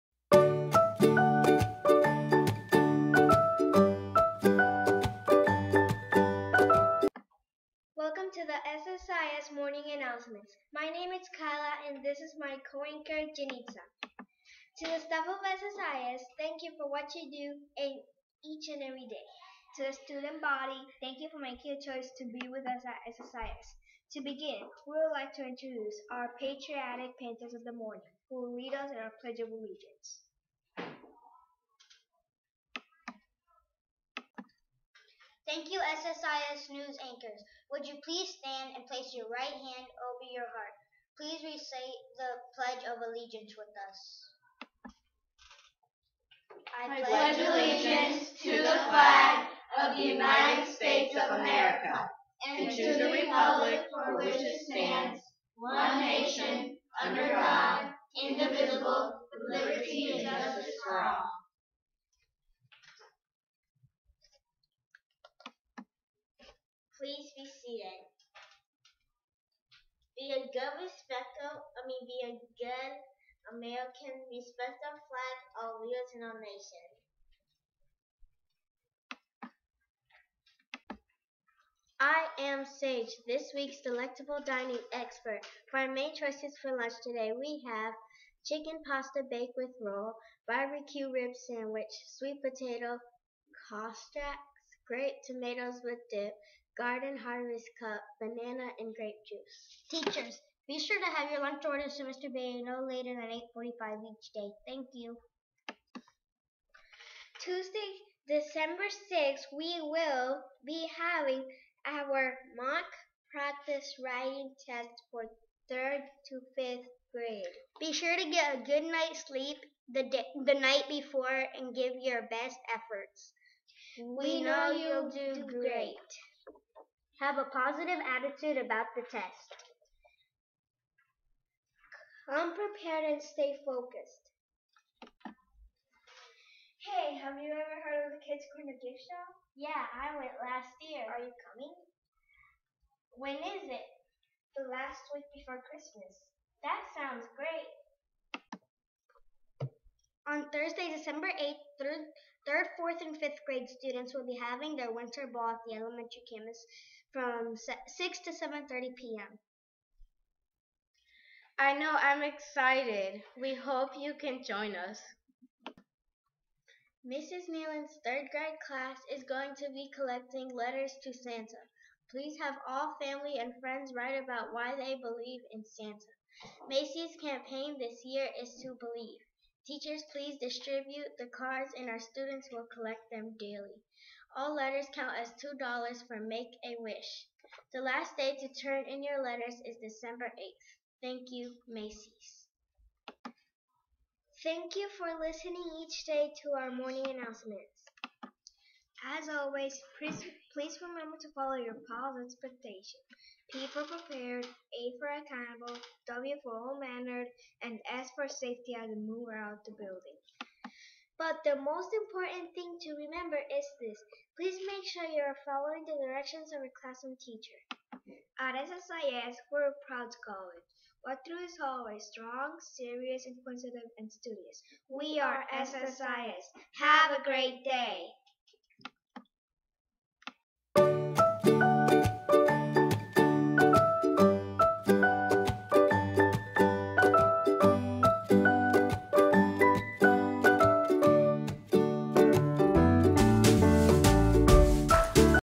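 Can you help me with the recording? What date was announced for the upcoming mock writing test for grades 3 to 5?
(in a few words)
Tuesday, December 6th.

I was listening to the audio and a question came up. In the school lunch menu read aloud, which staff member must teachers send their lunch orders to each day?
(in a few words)
Mr. Bay.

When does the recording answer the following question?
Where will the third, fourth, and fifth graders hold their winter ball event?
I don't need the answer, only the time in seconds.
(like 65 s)
155 s.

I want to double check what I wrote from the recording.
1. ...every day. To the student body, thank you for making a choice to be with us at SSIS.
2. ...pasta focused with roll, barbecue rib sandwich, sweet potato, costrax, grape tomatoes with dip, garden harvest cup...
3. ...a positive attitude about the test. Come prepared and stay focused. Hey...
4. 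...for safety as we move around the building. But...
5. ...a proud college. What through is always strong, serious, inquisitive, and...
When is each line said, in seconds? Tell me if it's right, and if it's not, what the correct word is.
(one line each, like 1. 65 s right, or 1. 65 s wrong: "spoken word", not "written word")
1. 18 s right
2. 88 s wrong: "baked", not "focused"
3. 127 s right
4. 208 s right
5. 219 s right.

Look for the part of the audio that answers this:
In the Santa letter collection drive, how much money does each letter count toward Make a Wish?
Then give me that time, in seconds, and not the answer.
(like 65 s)
185 s.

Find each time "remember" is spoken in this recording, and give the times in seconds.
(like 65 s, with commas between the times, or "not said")
200 s, 213 s.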